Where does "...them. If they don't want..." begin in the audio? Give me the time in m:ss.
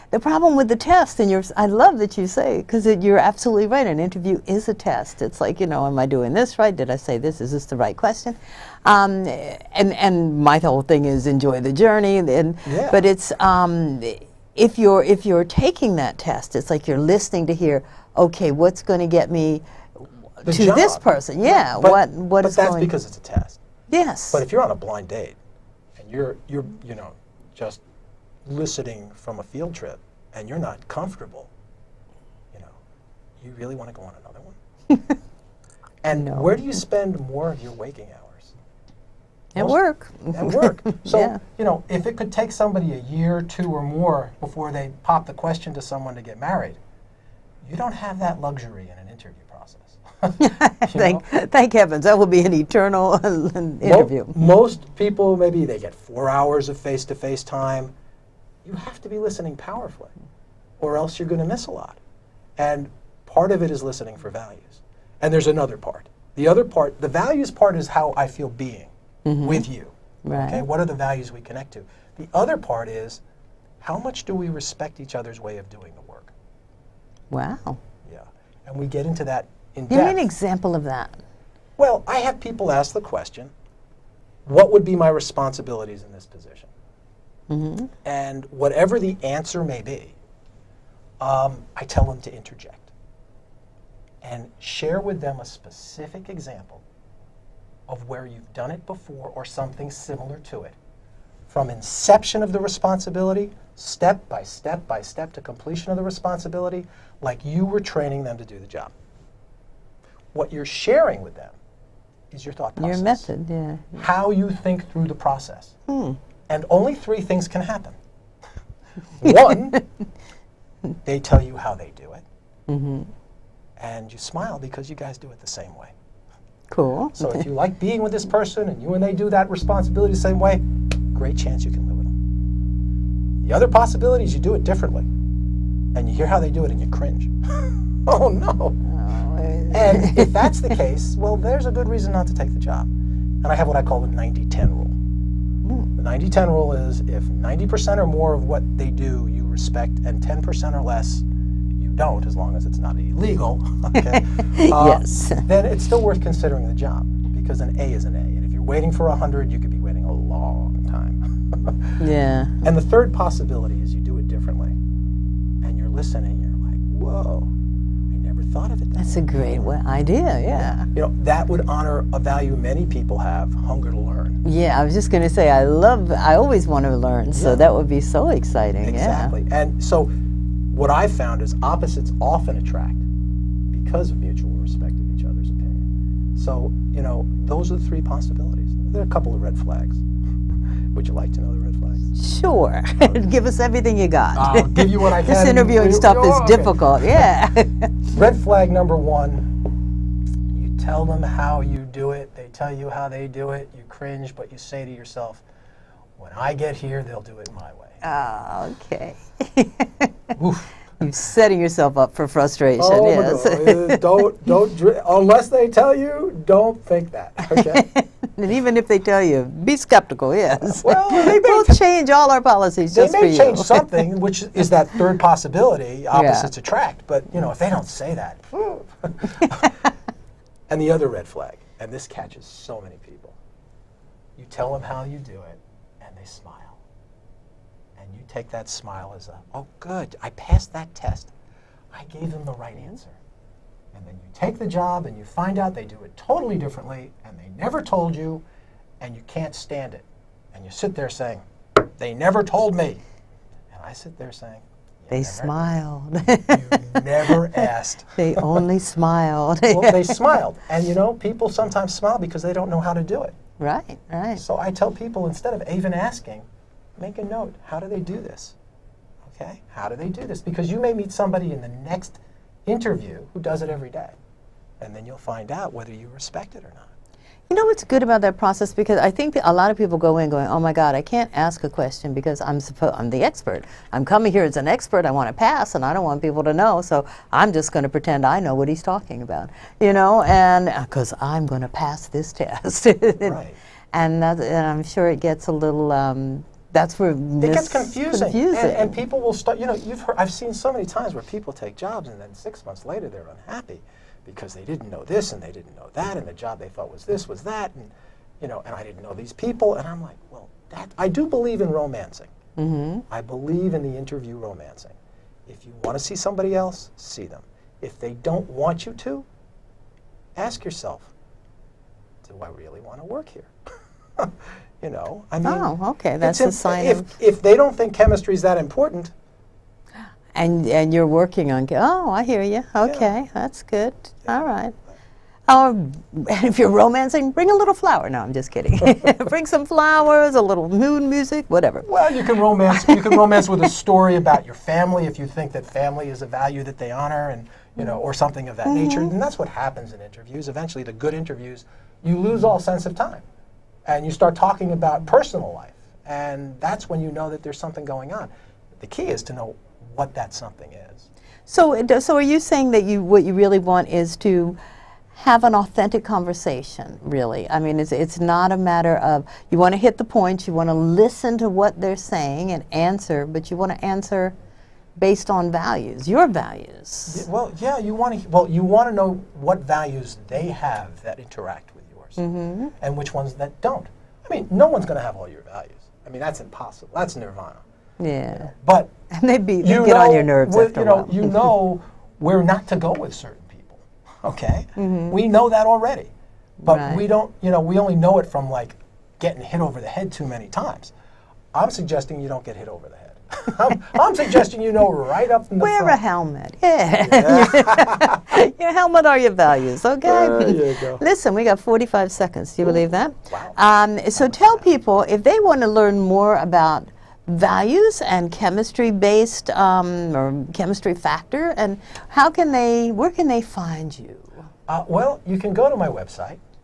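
5:17.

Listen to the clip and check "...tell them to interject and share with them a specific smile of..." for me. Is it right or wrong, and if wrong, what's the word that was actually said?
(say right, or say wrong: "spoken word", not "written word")
wrong: "example", not "smile".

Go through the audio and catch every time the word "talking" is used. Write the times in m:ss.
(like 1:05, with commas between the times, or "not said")
4:48, 5:54.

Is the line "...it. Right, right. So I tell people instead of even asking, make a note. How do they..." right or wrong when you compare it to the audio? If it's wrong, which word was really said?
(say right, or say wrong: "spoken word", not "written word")
right.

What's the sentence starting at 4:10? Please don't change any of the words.
And you sit there saying, they never told me.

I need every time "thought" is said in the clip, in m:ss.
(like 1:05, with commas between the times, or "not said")
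1:52, 2:48, 5:06.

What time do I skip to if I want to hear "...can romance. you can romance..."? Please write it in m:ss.
5:42.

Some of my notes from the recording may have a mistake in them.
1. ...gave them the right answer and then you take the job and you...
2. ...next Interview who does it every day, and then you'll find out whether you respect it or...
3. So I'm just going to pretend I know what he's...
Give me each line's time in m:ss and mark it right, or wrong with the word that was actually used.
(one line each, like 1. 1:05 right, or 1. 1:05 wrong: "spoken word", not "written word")
1. 4:02 right
2. 4:31 right
3. 4:46 right.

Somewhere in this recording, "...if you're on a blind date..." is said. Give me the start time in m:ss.
0:24.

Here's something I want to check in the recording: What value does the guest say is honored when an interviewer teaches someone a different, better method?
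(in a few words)
hunger to learn.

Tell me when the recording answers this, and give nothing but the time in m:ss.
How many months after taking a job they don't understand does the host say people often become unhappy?
5:02.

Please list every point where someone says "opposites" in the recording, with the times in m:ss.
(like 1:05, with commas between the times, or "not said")
3:01, 3:46.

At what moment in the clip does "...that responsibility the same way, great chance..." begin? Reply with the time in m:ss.
2:09.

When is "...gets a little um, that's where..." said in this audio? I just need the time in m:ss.
4:55.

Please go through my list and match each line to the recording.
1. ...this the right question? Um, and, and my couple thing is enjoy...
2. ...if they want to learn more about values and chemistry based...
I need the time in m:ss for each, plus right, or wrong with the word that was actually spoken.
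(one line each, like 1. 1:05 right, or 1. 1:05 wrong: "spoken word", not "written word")
1. 0:07 wrong: "whole", not "couple"
2. 6:55 right.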